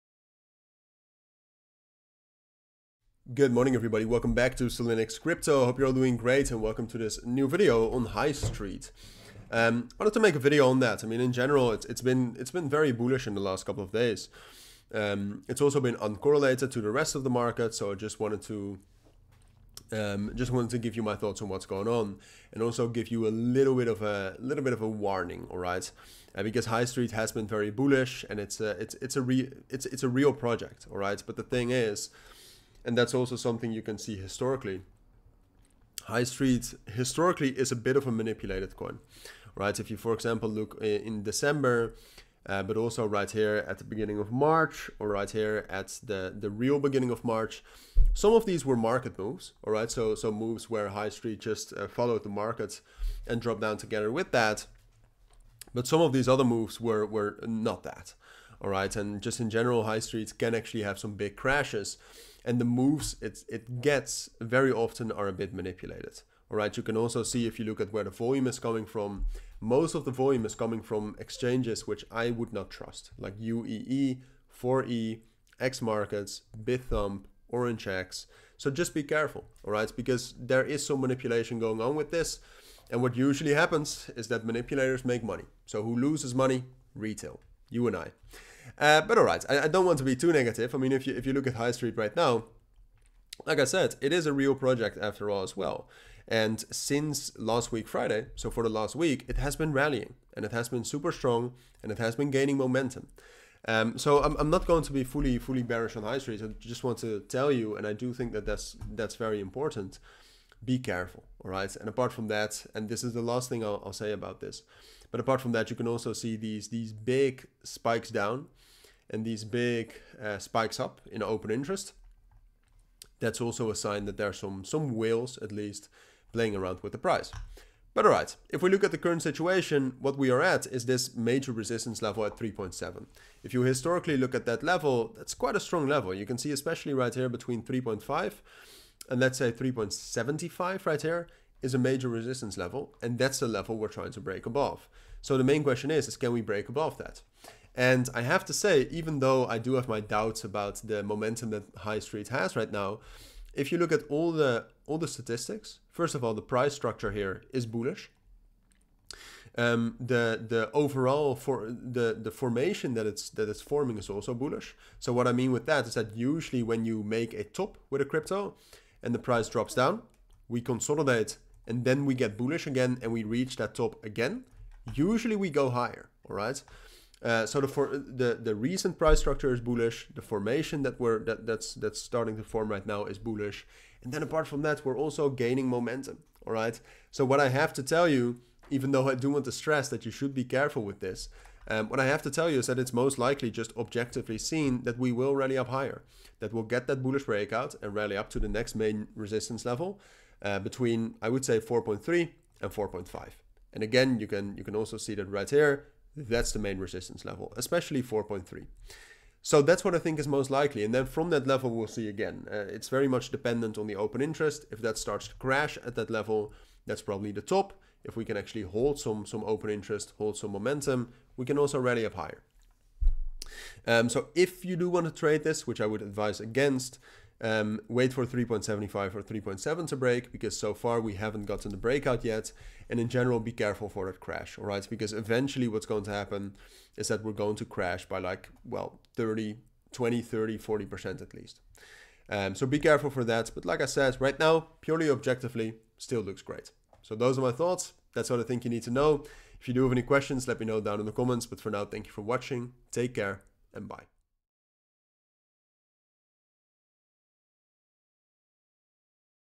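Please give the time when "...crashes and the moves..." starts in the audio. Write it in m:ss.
1:01.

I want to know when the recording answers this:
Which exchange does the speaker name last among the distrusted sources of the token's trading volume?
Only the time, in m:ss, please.
1:17.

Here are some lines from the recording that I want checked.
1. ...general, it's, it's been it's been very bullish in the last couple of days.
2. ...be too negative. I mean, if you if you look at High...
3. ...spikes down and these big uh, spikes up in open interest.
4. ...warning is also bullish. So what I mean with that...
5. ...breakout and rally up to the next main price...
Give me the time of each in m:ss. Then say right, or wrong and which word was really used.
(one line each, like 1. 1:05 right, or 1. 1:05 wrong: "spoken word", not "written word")
1. 0:11 right
2. 1:30 right
3. 1:57 right
4. 2:43 wrong: "forming", not "warning"
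5. 3:17 wrong: "resistance", not "price".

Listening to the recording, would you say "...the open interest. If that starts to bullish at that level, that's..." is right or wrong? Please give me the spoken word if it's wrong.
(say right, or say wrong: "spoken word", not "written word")
wrong: "crash", not "bullish".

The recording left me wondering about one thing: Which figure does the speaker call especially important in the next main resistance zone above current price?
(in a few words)
4.3.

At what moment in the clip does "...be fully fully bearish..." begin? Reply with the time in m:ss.
1:44.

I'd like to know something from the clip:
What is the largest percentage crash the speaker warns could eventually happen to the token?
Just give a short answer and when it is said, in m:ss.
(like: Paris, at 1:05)
40%, at 4:00.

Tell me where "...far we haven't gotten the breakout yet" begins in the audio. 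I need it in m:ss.
3:50.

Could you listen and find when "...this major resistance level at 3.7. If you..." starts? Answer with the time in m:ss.
2:10.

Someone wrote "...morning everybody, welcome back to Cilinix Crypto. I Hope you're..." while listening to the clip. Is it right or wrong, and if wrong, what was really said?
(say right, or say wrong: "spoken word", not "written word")
right.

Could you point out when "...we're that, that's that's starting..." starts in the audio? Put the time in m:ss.
3:00.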